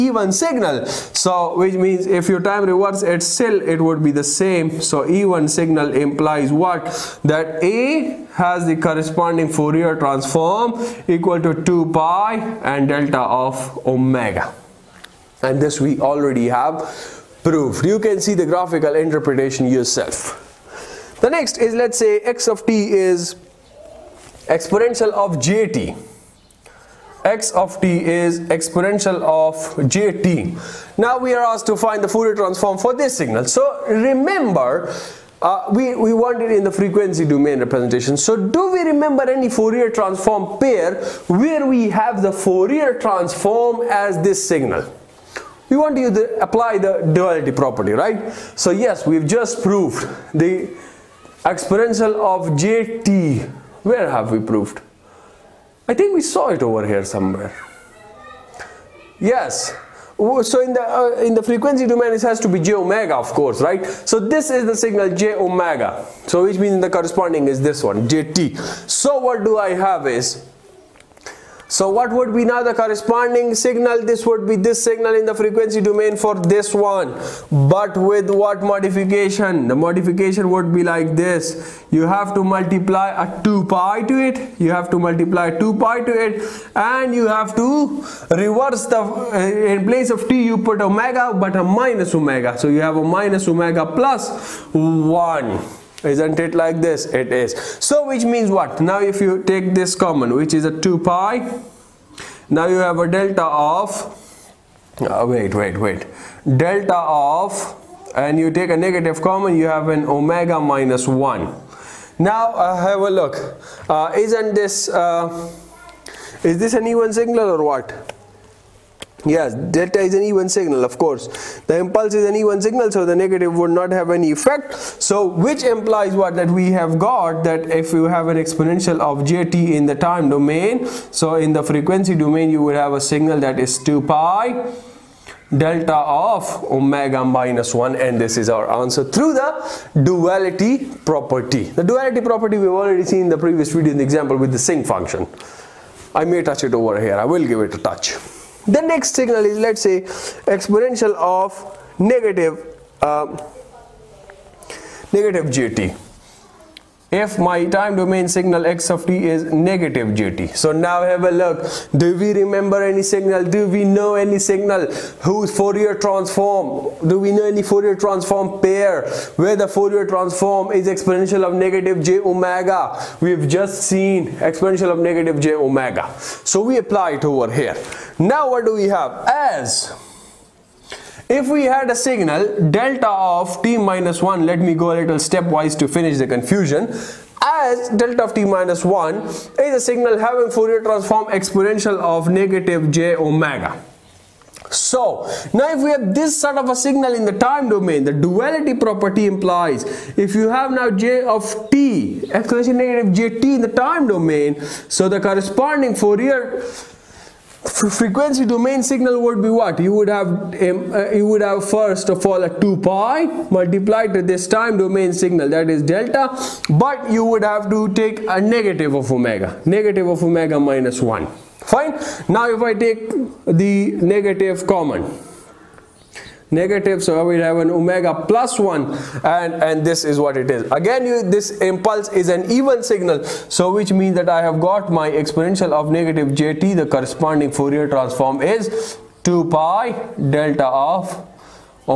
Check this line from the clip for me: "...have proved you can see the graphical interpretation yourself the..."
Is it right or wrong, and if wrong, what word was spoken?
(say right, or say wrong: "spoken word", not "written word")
right.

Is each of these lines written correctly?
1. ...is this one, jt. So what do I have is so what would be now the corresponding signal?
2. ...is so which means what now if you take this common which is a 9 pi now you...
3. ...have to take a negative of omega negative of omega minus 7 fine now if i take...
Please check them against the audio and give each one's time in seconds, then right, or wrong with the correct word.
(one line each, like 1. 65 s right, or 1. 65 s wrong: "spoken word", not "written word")
1. 67 s right
2. 97 s wrong: "2", not "9"
3. 217 s wrong: "1", not "7".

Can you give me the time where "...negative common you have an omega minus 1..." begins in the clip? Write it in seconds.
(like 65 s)
108 s.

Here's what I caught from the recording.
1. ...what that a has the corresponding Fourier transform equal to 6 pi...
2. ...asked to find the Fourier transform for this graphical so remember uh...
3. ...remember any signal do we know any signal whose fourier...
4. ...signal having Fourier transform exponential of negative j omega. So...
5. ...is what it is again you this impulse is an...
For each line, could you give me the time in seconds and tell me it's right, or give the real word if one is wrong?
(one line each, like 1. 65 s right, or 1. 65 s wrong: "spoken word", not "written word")
1. 6 s wrong: "2", not "6"
2. 31 s wrong: "signal", not "graphical"
3. 162 s right
4. 189 s right
5. 230 s right.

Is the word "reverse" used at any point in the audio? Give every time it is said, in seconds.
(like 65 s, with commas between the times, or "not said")
2 s, 88 s.